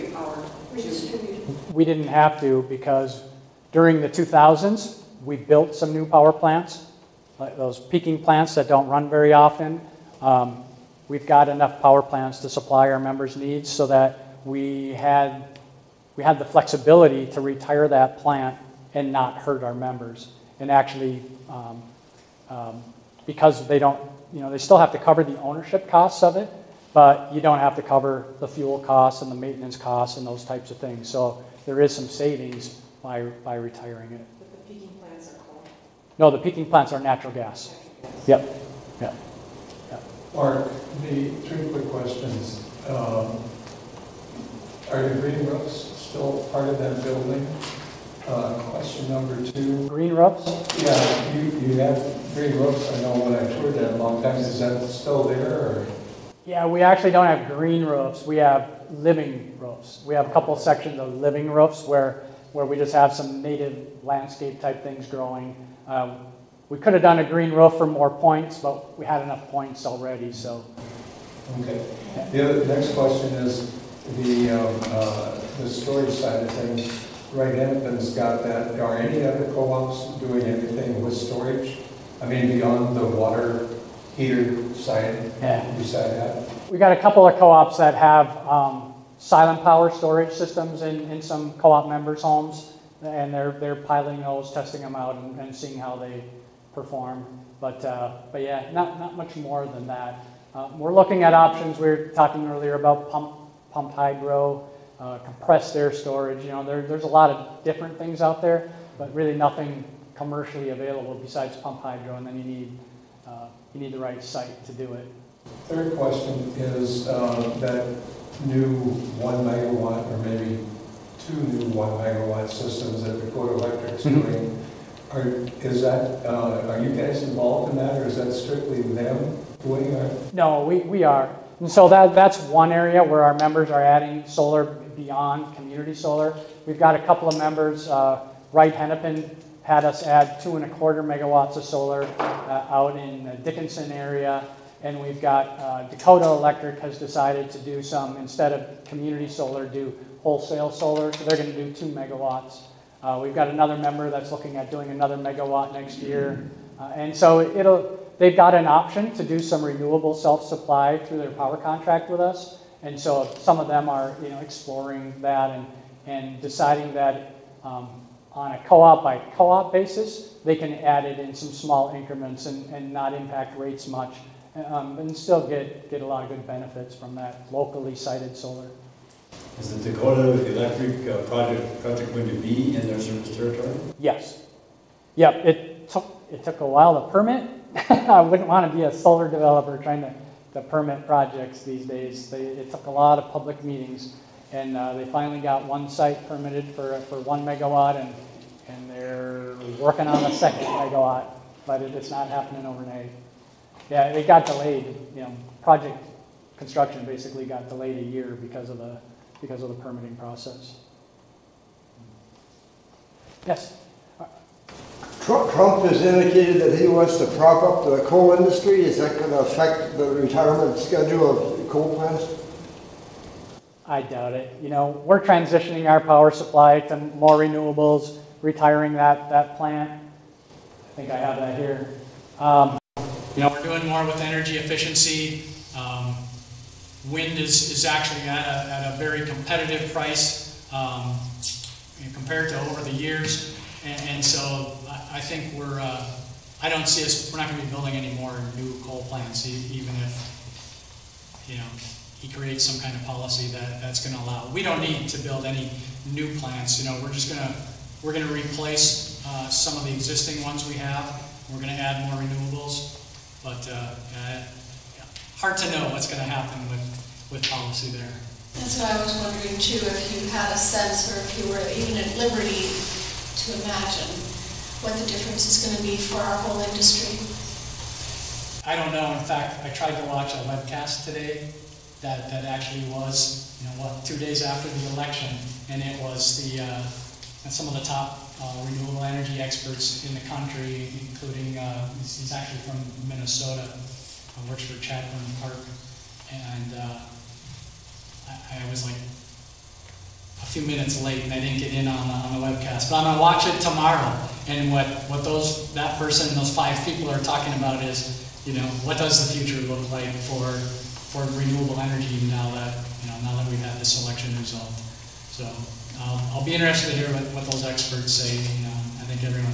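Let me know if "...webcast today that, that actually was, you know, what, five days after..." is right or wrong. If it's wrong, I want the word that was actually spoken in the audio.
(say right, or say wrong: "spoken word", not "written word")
wrong: "two", not "five".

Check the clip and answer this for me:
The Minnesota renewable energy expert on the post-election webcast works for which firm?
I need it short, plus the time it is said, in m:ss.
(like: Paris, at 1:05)
Chadbourne Parke, at 4:54.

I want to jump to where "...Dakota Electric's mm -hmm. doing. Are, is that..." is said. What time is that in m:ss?
2:03.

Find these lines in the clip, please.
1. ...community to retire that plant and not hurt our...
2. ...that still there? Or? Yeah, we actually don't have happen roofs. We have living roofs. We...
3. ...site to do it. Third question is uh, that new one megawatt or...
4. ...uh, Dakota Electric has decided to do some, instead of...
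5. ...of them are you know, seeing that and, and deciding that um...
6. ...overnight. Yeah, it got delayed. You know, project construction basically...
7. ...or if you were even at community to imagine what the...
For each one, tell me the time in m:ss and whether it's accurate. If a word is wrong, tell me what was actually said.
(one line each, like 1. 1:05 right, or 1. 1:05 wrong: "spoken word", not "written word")
1. 0:16 wrong: "flexibility", not "community"
2. 0:54 wrong: "green", not "happen"
3. 1:54 right
4. 2:25 right
5. 2:43 wrong: "exploring", not "seeing"
6. 3:22 right
7. 4:31 wrong: "liberty", not "community".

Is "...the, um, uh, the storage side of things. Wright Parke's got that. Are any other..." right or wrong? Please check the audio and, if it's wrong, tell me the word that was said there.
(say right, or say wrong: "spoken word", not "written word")
wrong: "Hennepin", not "Parke".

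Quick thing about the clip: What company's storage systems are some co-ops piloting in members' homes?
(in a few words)
Silent Power.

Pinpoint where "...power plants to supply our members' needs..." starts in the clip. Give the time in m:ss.
0:11.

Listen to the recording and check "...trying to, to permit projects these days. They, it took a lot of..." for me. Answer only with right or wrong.
right.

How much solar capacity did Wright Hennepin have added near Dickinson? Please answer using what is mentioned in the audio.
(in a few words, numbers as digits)
2.25 megawatts.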